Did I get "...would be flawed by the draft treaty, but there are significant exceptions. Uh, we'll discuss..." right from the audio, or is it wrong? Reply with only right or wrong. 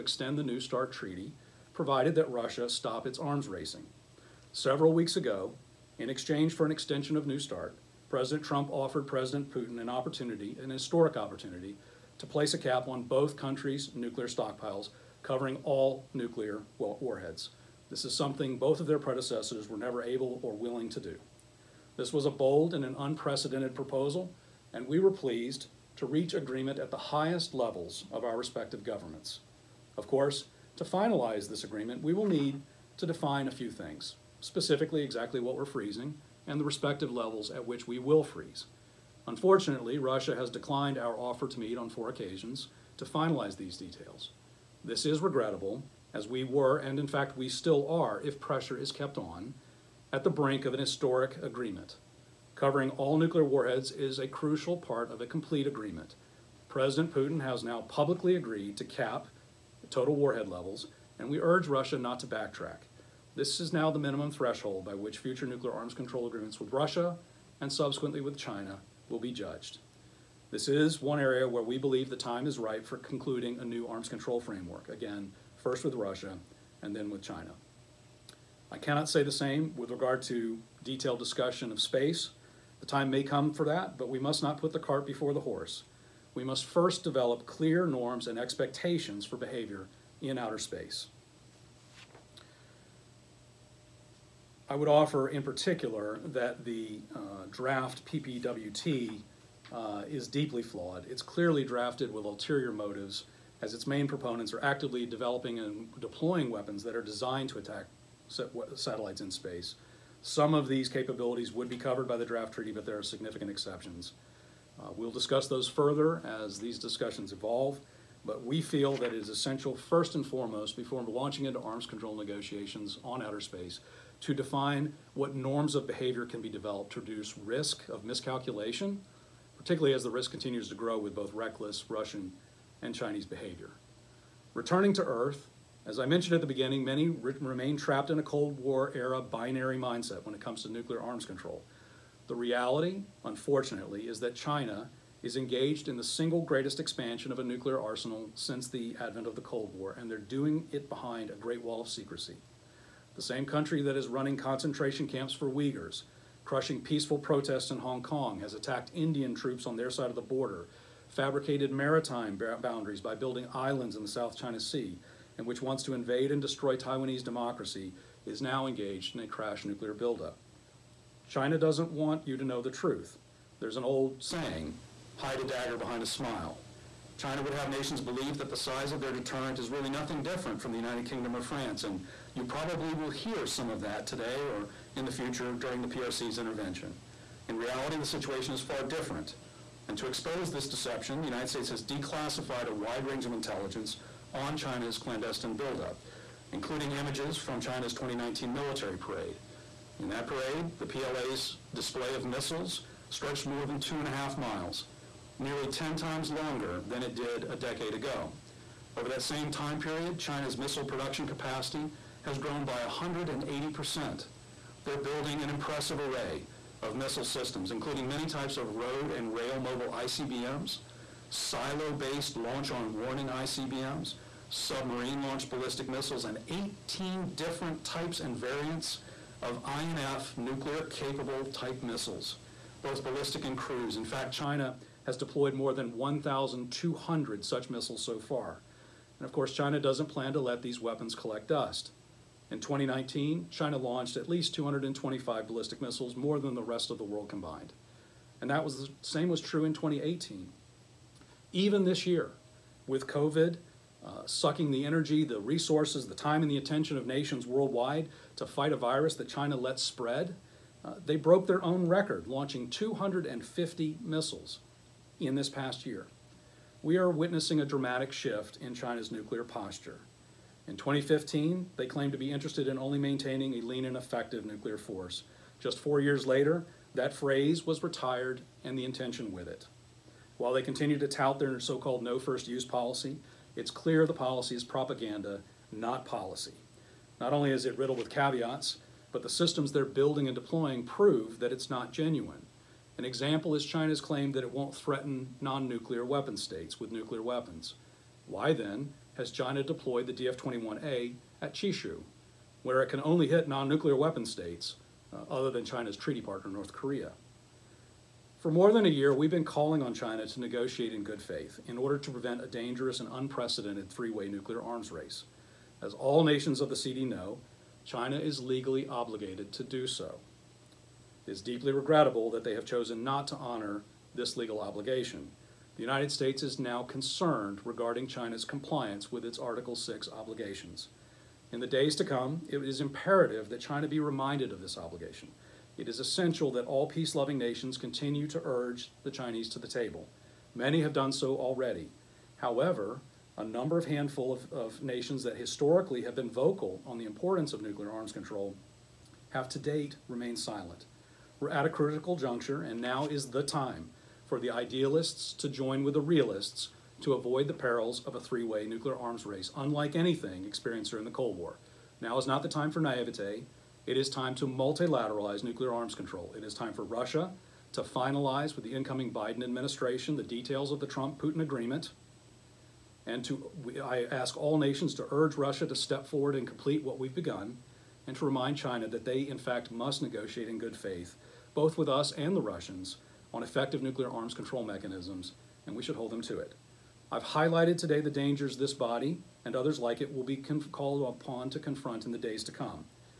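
wrong.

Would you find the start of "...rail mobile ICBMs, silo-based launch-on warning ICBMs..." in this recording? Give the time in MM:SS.
03:39.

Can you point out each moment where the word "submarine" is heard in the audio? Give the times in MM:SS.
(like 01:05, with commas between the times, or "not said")
03:44.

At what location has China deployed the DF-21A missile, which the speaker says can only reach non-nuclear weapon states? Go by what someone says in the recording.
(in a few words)
Chishu.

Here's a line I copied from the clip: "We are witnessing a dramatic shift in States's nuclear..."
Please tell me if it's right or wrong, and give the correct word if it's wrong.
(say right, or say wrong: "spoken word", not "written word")
wrong: "China", not "States".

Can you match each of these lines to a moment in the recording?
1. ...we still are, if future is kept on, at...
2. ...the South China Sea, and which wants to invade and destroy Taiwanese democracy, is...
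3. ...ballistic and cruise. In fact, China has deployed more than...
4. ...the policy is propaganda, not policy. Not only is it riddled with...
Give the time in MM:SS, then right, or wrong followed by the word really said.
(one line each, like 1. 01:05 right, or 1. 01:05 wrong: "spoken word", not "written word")
1. 00:47 wrong: "pressure", not "future"
2. 02:44 right
3. 03:53 right
4. 04:44 right.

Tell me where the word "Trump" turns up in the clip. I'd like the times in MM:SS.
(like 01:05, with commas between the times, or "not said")
00:08, 06:10.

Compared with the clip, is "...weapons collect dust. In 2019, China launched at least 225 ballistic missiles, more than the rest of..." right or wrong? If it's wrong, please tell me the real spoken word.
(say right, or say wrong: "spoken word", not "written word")
right.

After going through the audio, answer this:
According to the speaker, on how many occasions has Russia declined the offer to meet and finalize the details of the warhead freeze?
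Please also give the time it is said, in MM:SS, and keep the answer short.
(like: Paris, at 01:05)
4, at 00:41.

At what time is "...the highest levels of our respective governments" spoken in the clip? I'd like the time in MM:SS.
00:26.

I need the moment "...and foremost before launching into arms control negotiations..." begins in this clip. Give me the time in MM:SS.
02:00.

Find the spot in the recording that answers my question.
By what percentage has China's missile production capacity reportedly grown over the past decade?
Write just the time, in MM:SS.
03:32.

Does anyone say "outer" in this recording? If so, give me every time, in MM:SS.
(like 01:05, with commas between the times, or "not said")
01:30, 02:03.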